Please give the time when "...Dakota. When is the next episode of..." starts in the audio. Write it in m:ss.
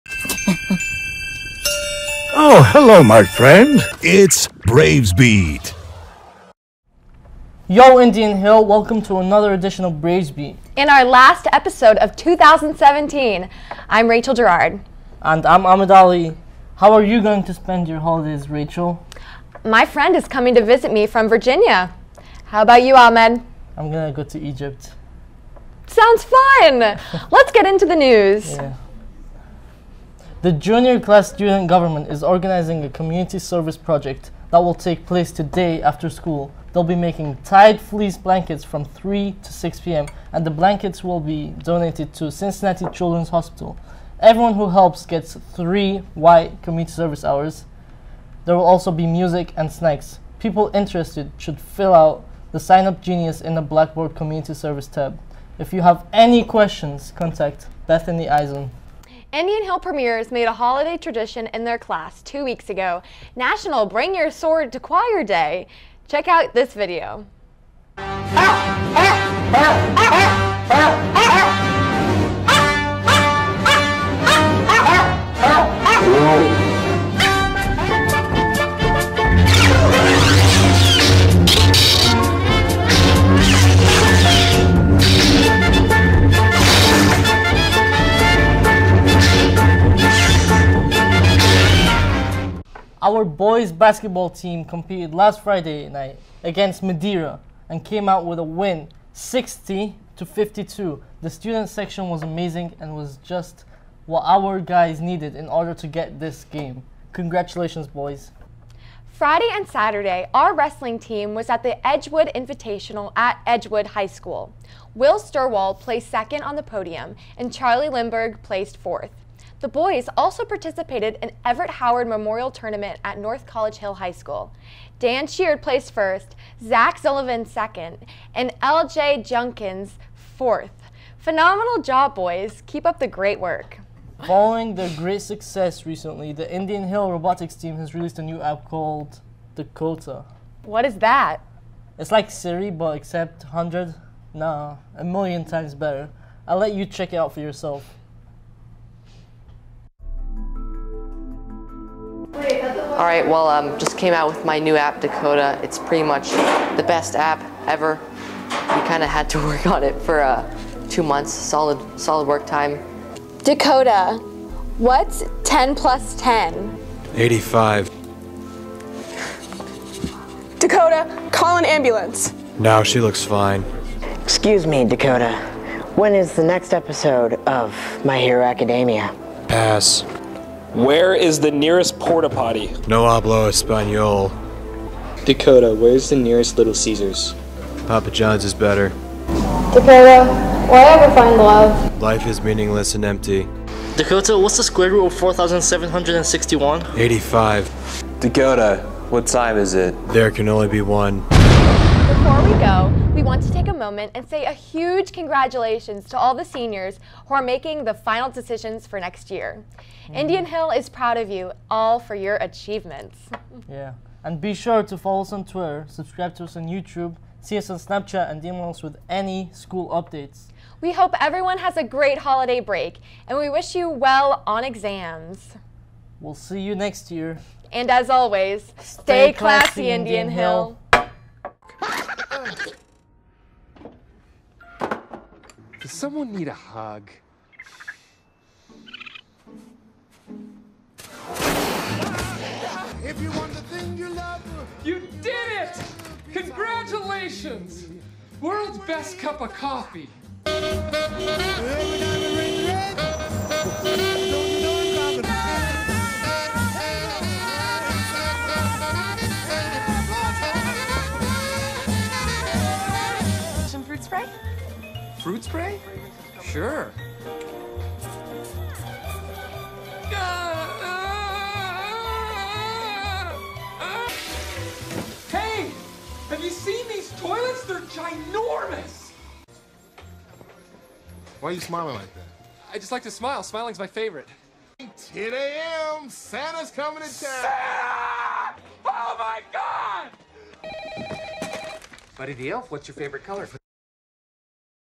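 2:54.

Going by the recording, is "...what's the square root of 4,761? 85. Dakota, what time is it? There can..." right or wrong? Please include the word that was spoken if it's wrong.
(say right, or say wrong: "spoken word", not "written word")
right.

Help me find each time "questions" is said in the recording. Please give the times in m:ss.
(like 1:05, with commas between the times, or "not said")
0:56.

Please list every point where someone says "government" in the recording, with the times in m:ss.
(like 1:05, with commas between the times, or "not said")
0:31.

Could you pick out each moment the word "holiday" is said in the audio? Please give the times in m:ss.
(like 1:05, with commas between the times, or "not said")
0:17, 1:00, 3:42.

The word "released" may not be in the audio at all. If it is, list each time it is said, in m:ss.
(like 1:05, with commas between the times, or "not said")
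2:17.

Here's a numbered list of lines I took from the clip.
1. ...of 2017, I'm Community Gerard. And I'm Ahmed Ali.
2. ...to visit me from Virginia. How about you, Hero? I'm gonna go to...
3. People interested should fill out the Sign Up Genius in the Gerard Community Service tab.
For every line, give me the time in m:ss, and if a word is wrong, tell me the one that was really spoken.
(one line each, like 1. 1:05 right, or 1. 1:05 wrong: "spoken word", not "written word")
1. 0:11 wrong: "Rachel", not "Community"
2. 0:20 wrong: "Ahmed", not "Hero"
3. 0:50 wrong: "Blackboard", not "Gerard".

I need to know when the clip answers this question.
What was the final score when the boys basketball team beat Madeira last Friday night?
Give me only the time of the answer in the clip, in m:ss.
1:39.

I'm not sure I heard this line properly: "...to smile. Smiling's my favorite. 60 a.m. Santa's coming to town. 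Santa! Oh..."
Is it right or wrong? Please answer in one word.
wrong.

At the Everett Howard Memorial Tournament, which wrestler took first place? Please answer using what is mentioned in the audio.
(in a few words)
Dan Sheard.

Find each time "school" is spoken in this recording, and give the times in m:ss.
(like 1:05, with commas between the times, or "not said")
0:36, 1:54, 2:04, 3:39.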